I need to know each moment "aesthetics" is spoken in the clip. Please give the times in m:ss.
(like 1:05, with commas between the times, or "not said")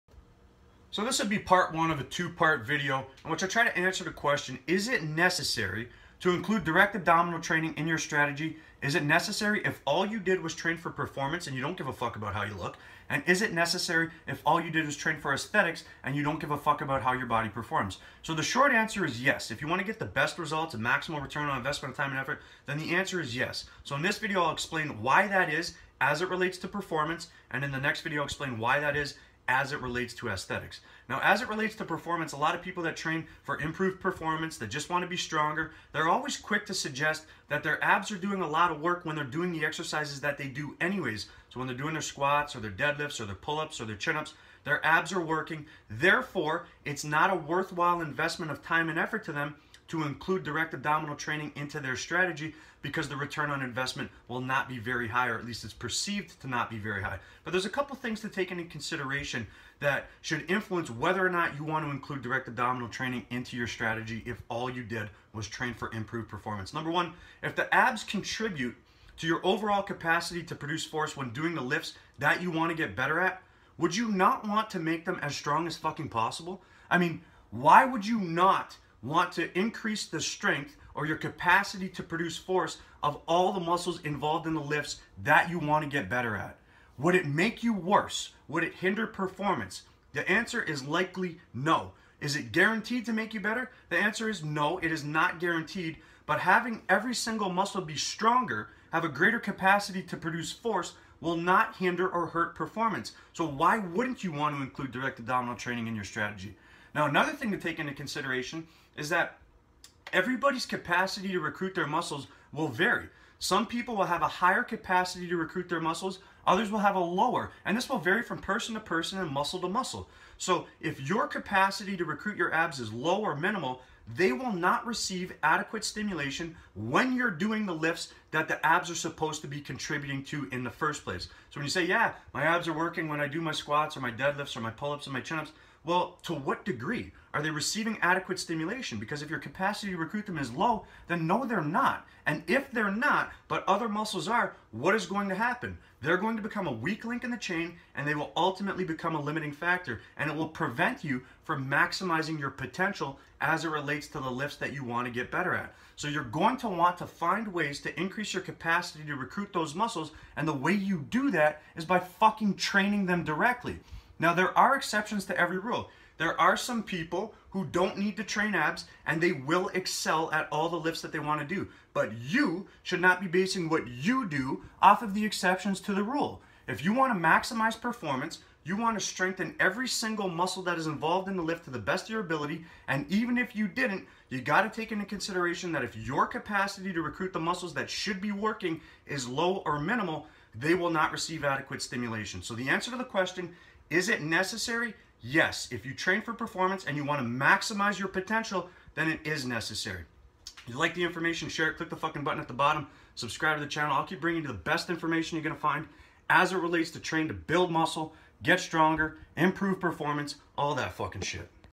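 0:15, 0:30.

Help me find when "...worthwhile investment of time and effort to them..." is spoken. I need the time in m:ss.
0:47.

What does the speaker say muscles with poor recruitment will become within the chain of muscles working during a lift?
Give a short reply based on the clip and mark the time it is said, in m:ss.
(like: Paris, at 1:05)
A weak link, at 2:26.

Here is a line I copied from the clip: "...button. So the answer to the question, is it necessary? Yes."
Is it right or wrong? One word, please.
wrong.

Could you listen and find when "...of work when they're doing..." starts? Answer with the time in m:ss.
0:38.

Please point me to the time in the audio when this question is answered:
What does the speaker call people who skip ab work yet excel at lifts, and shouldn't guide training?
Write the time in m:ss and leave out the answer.
2:55.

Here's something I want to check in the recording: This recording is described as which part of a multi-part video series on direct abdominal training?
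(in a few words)
Part one.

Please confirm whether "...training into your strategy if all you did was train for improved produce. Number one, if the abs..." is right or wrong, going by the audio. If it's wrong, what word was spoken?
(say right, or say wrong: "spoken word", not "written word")
wrong: "performance", not "produce".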